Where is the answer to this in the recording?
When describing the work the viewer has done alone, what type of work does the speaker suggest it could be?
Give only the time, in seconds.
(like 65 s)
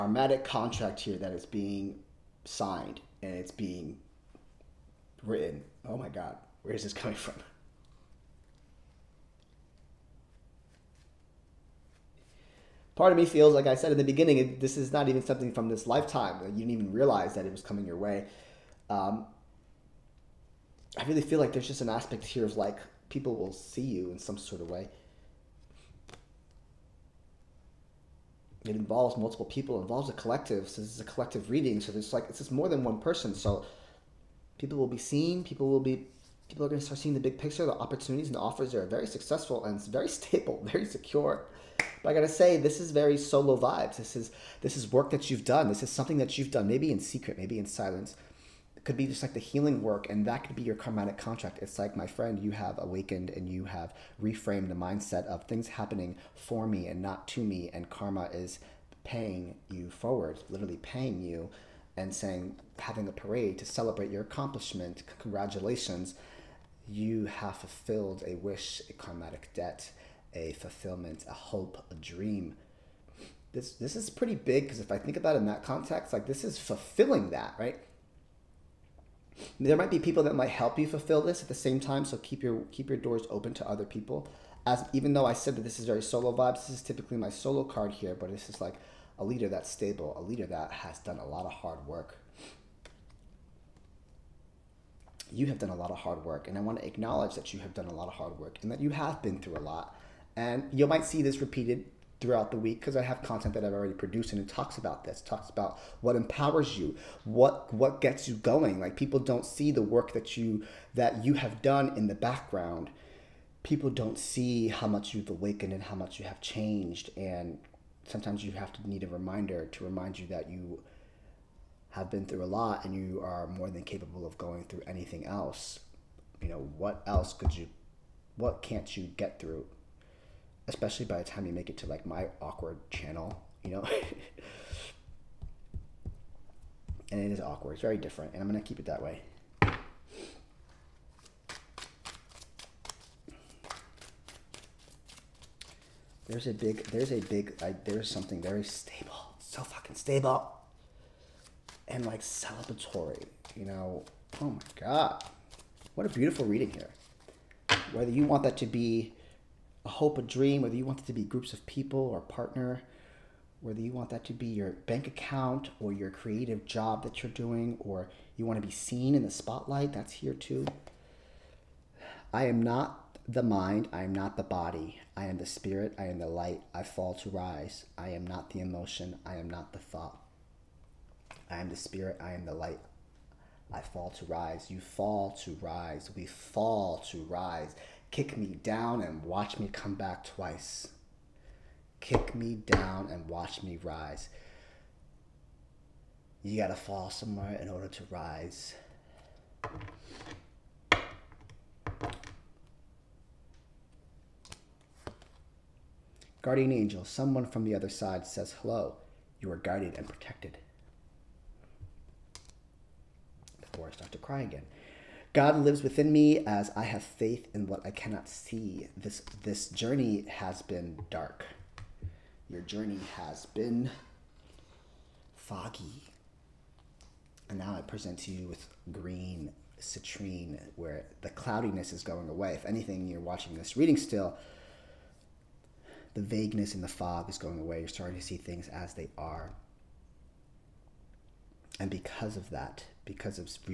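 49 s.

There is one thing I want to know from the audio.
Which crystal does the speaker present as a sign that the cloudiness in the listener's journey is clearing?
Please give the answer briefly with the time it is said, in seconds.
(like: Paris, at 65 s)
Green citrine, at 228 s.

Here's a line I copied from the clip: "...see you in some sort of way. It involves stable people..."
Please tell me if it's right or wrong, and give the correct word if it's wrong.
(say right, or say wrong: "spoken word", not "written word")
wrong: "multiple", not "stable".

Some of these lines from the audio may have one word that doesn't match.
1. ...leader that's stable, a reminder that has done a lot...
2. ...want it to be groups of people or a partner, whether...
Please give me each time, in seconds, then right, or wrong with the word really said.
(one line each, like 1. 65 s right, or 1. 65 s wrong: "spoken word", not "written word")
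1. 89 s wrong: "leader", not "reminder"
2. 160 s right.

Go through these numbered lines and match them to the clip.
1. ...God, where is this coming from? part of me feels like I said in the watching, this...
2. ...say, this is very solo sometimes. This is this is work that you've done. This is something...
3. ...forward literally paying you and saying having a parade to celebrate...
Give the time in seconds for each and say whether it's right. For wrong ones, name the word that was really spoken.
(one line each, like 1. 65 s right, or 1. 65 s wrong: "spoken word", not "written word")
1. 6 s wrong: "beginning", not "watching"
2. 42 s wrong: "vibes", not "sometimes"
3. 59 s right.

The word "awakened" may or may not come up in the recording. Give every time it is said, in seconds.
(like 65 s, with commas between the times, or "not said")
52 s, 115 s.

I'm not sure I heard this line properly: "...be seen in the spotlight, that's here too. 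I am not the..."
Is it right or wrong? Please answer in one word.
right.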